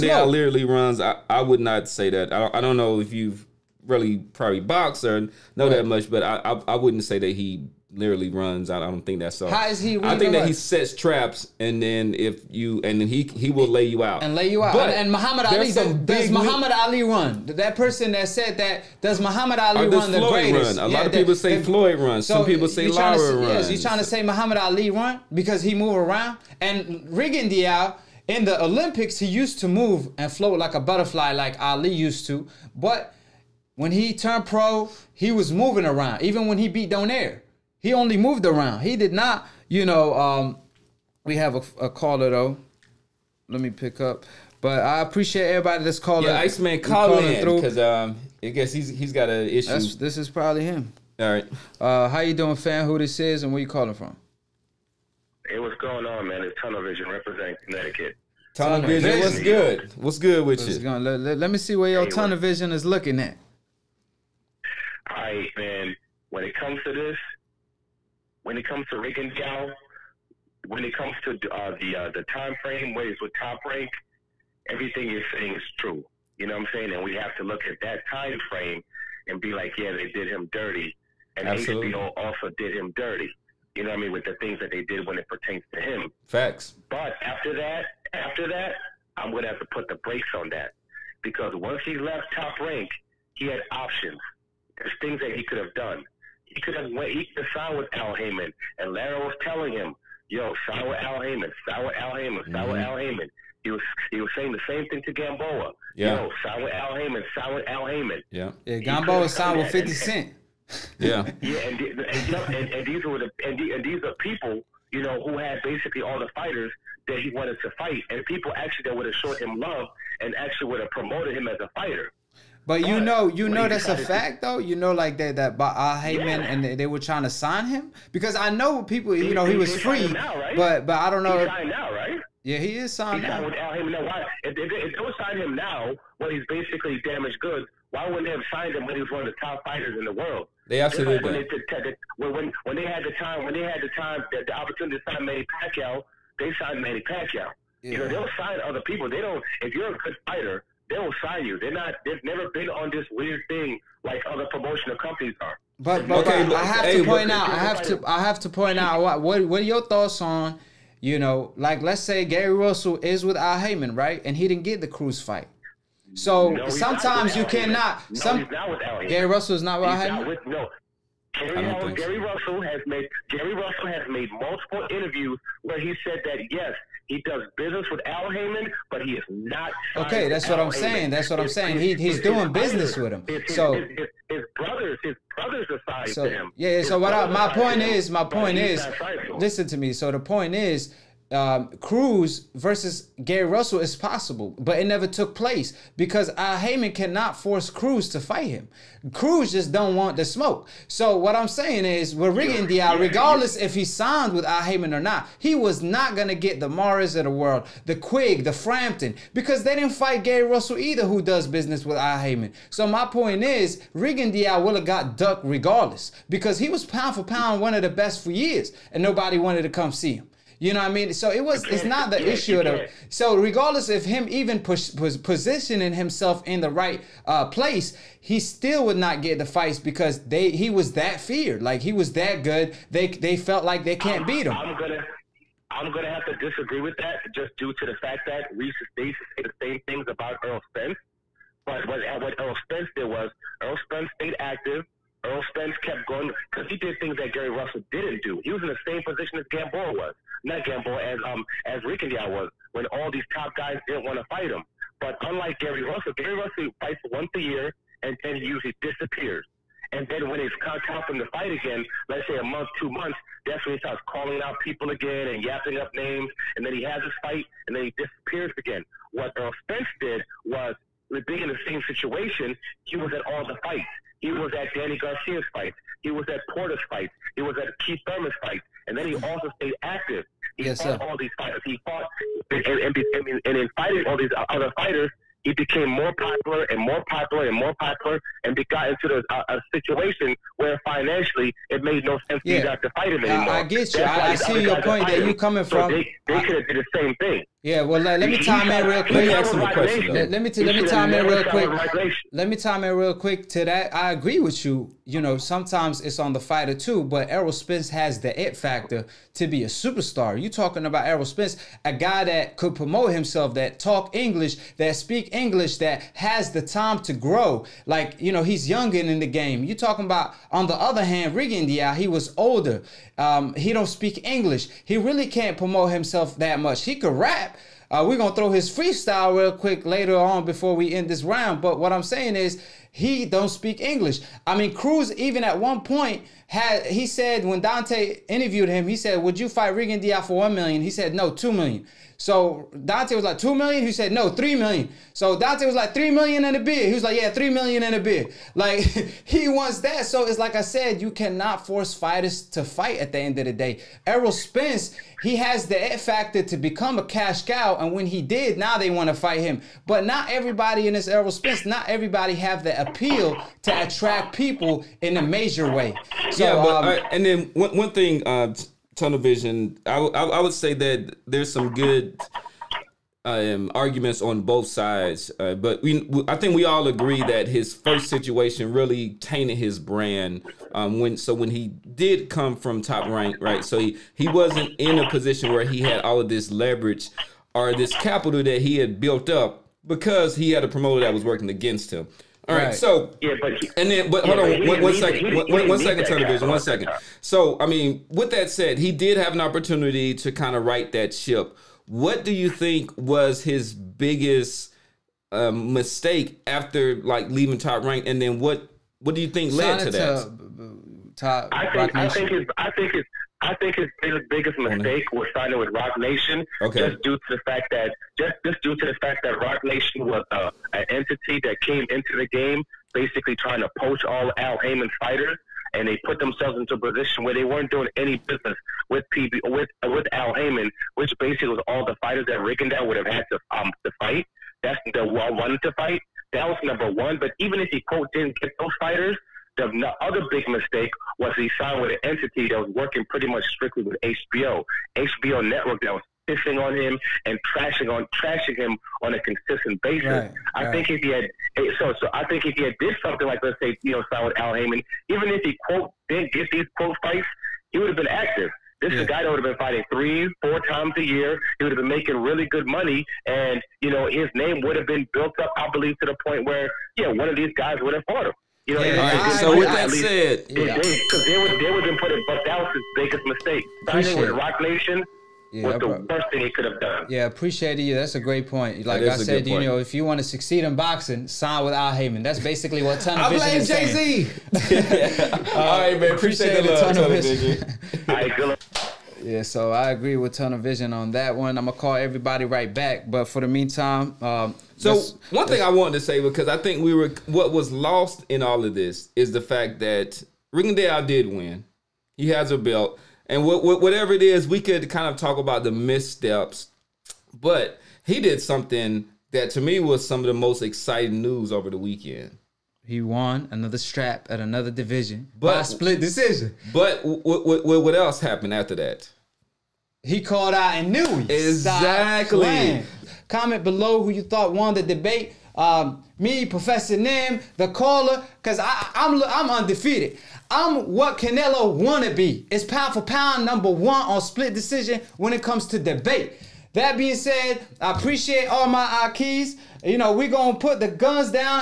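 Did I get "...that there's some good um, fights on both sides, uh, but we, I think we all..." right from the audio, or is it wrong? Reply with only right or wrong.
wrong.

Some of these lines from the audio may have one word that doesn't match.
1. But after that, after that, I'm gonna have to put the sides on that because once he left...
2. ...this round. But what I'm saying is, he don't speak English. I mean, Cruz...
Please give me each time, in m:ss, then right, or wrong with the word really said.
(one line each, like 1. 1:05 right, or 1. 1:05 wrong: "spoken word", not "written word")
1. 1:26 wrong: "brakes", not "sides"
2. 5:31 right.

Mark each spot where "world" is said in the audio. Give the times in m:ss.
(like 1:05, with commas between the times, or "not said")
2:20, 3:27.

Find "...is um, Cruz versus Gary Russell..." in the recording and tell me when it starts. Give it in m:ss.
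3:10.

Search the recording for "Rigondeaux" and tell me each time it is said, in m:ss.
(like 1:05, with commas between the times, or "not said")
0:27, 1:08, 3:33, 4:11, 5:21, 5:39, 7:12, 8:20.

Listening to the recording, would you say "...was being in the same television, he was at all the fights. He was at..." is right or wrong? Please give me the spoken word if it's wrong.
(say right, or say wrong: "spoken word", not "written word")
wrong: "situation", not "television".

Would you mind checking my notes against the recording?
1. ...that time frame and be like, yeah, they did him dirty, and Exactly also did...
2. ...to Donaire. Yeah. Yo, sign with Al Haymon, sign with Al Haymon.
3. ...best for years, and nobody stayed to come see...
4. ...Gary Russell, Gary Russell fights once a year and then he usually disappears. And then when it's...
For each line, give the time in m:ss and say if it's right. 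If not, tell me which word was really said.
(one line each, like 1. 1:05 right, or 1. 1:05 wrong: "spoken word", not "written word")
1. 1:17 wrong: "HBO", not "Exactly"
2. 1:45 wrong: "Gamboa", not "Donaire"
3. 3:37 wrong: "wanted", not "stayed"
4. 4:15 right.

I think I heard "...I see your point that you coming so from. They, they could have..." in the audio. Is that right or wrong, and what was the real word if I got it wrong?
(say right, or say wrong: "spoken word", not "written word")
right.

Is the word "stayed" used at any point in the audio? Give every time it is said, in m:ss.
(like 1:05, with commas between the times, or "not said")
4:04, 4:39.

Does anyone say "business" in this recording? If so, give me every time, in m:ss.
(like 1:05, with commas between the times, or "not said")
2:57, 3:02, 3:31, 7:08.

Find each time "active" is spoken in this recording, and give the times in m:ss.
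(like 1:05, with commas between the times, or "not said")
4:04, 4:39, 7:38.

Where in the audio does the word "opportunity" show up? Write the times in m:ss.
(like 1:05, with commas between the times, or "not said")
2:24, 6:39.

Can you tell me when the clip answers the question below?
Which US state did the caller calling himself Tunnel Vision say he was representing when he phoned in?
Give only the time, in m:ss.
0:57.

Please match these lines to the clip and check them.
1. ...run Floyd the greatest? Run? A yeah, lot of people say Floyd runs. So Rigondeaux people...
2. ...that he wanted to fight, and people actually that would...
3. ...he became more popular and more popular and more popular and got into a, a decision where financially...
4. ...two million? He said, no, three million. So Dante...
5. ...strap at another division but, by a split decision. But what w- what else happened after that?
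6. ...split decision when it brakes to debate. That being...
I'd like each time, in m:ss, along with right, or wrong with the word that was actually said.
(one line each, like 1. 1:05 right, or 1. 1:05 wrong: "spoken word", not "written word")
1. 0:19 wrong: "Some", not "Rigondeaux"
2. 1:57 right
3. 4:45 wrong: "situation", not "decision"
4. 5:43 right
5. 8:33 right
6. 8:54 wrong: "comes", not "brakes".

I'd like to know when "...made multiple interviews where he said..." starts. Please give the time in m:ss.
2:54.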